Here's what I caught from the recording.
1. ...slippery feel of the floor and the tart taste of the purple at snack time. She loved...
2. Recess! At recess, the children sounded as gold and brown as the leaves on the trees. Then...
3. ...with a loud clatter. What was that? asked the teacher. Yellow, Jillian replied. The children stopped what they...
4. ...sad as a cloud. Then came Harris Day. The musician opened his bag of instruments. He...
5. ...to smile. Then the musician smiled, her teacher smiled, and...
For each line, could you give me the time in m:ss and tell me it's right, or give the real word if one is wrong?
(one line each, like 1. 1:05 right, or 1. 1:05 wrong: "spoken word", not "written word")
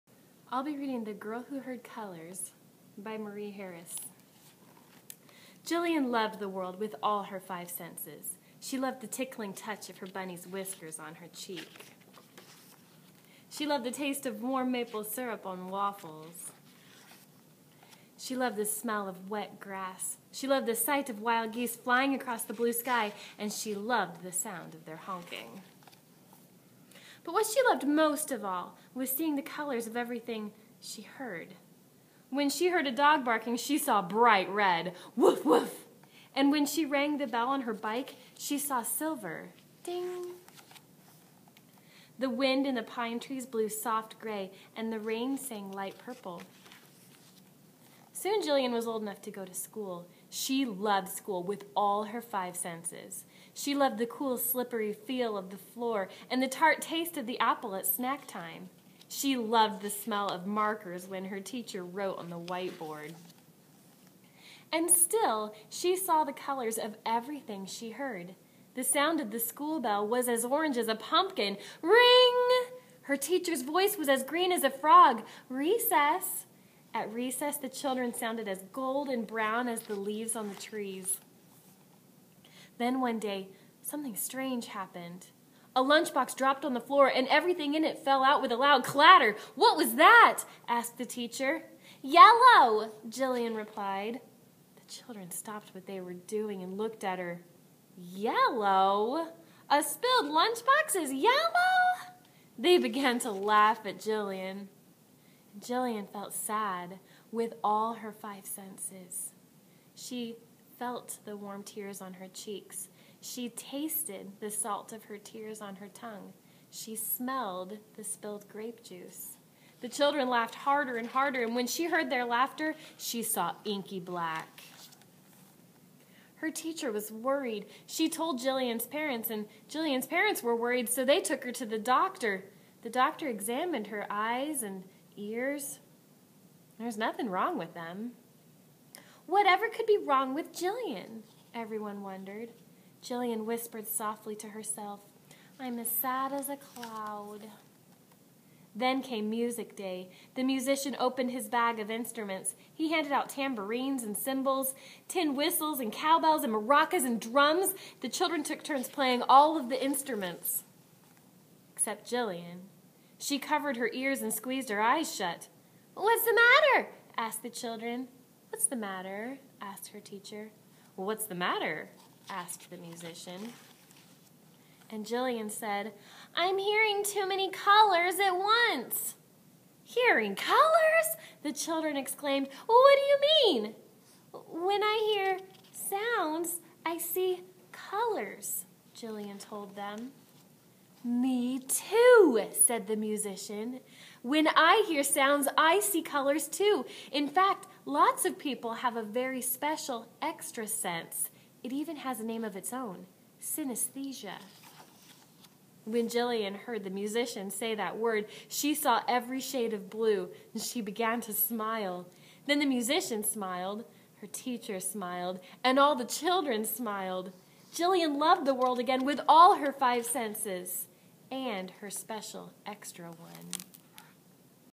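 1. 0:54 wrong: "apple", not "purple"
2. 1:15 right
3. 1:28 right
4. 2:25 wrong: "Music", not "Harris"
5. 3:31 right.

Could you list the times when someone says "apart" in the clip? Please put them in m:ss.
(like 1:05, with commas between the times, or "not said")
not said.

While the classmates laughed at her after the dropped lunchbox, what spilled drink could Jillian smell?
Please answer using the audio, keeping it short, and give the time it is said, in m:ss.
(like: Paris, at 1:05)
Grape juice, at 1:58.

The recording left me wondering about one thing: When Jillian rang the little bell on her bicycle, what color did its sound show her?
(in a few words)
Silver.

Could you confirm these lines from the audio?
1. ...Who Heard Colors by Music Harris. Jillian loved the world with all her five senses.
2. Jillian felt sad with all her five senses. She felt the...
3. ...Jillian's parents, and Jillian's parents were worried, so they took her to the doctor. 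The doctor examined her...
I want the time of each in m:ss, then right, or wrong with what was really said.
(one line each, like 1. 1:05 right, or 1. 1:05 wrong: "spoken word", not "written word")
1. 0:01 wrong: "Marie", not "Music"
2. 1:45 right
3. 2:08 right.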